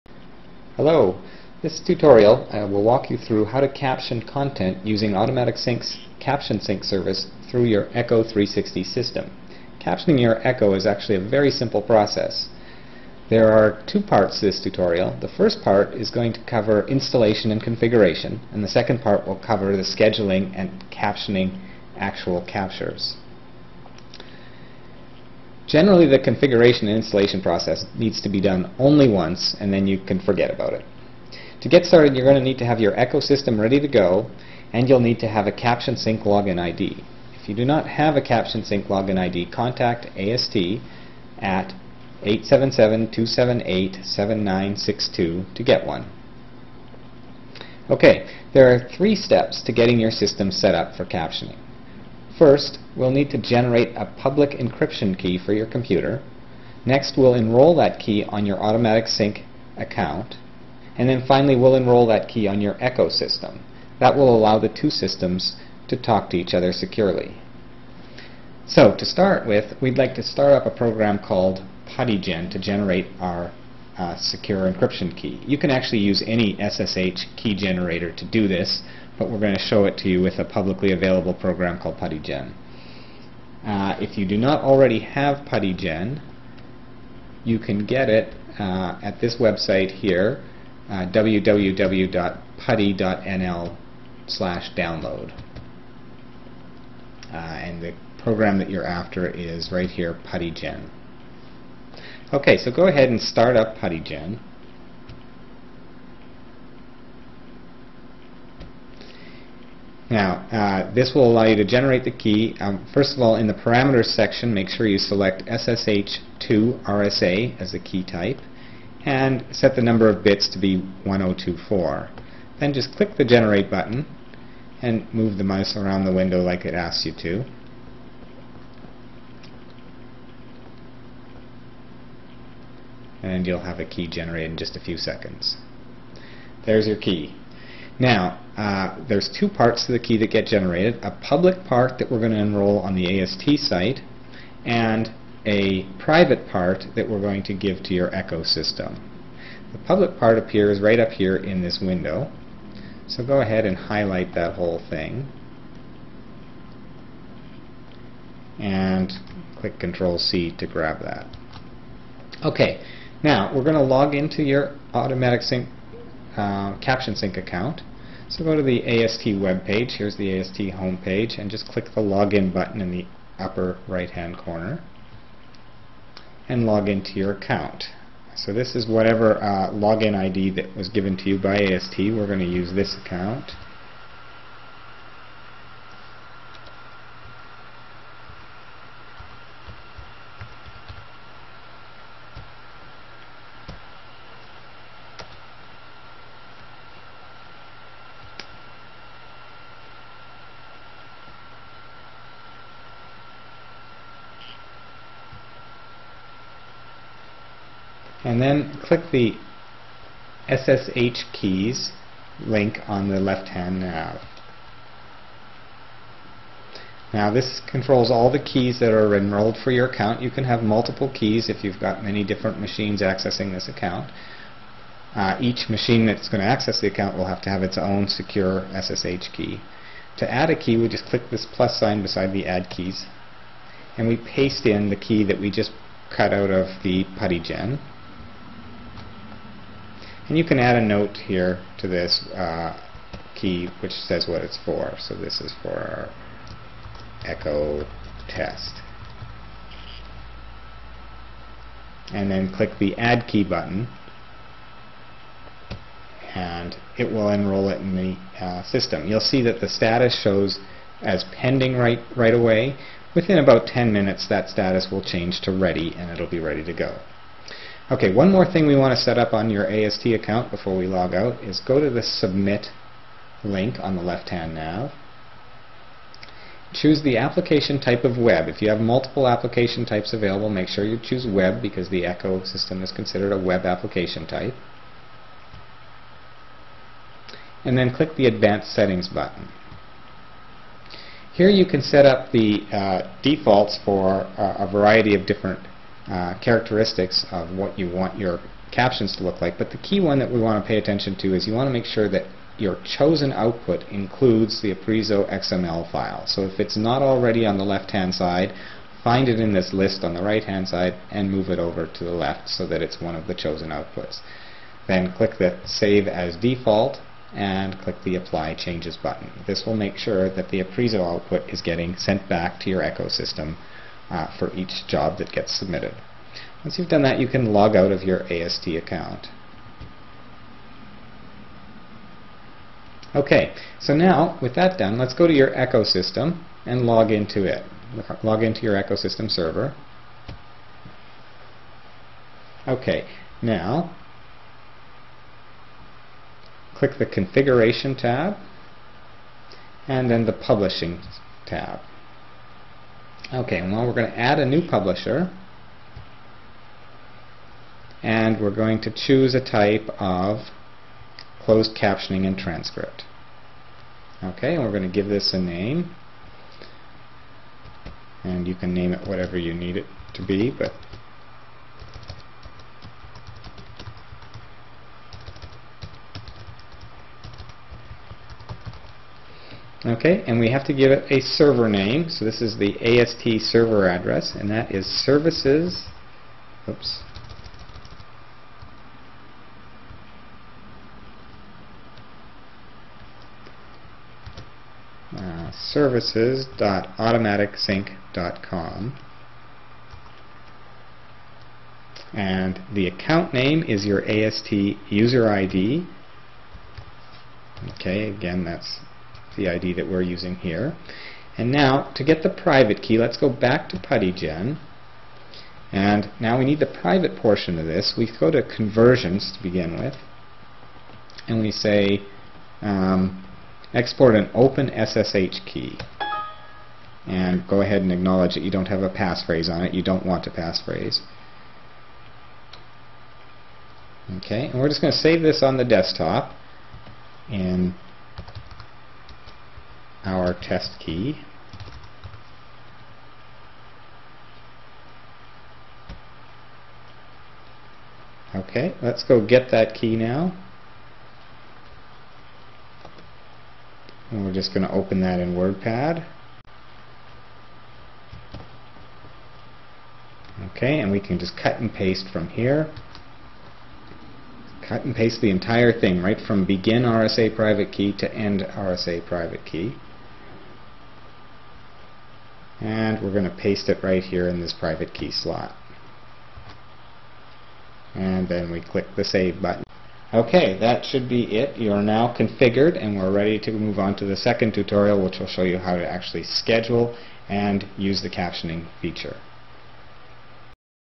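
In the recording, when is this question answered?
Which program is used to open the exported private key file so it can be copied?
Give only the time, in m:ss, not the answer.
7:35.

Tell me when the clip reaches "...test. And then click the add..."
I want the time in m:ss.
4:08.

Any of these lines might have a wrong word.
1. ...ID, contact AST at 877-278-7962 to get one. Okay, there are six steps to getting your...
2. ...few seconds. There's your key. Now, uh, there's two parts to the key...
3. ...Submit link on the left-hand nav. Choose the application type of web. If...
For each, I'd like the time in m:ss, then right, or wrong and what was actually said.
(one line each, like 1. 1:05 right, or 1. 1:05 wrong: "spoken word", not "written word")
1. 0:39 wrong: "three", not "six"
2. 2:14 right
3. 4:32 right.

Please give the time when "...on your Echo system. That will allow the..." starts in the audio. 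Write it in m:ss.
1:02.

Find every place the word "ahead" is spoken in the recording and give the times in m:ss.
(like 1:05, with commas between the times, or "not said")
1:42, 2:33, 7:07.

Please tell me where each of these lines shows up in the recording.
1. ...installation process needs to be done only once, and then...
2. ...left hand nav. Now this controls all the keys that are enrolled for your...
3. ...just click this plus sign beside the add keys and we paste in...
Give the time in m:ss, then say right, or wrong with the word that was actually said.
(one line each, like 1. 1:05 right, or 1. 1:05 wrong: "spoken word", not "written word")
1. 0:26 right
2. 3:33 right
3. 3:50 right.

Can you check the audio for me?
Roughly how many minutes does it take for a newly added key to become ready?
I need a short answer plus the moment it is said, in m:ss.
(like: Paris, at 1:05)
10, at 4:23.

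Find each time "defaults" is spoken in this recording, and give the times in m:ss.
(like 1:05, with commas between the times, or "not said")
4:53, 5:16.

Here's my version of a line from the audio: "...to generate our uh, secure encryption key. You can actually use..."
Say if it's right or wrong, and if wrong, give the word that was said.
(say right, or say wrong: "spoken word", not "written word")
right.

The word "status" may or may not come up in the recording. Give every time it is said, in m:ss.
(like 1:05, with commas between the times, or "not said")
4:19, 4:24.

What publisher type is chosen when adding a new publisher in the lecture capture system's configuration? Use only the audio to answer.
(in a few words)
closed captioning and transcript.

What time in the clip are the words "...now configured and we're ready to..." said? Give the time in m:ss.
8:01.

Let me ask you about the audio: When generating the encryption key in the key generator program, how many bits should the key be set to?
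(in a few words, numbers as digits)
1024.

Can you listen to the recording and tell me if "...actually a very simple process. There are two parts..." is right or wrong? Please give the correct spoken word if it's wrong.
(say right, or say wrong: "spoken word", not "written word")
right.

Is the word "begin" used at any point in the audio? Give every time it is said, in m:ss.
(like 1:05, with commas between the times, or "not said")
6:59, 7:46.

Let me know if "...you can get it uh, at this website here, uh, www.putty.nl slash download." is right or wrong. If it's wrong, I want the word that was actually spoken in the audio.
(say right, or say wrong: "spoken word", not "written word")
right.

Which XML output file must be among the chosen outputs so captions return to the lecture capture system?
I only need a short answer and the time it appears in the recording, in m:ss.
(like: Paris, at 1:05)
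Apreso XML, at 5:04.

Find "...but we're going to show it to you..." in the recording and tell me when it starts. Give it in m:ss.
1:19.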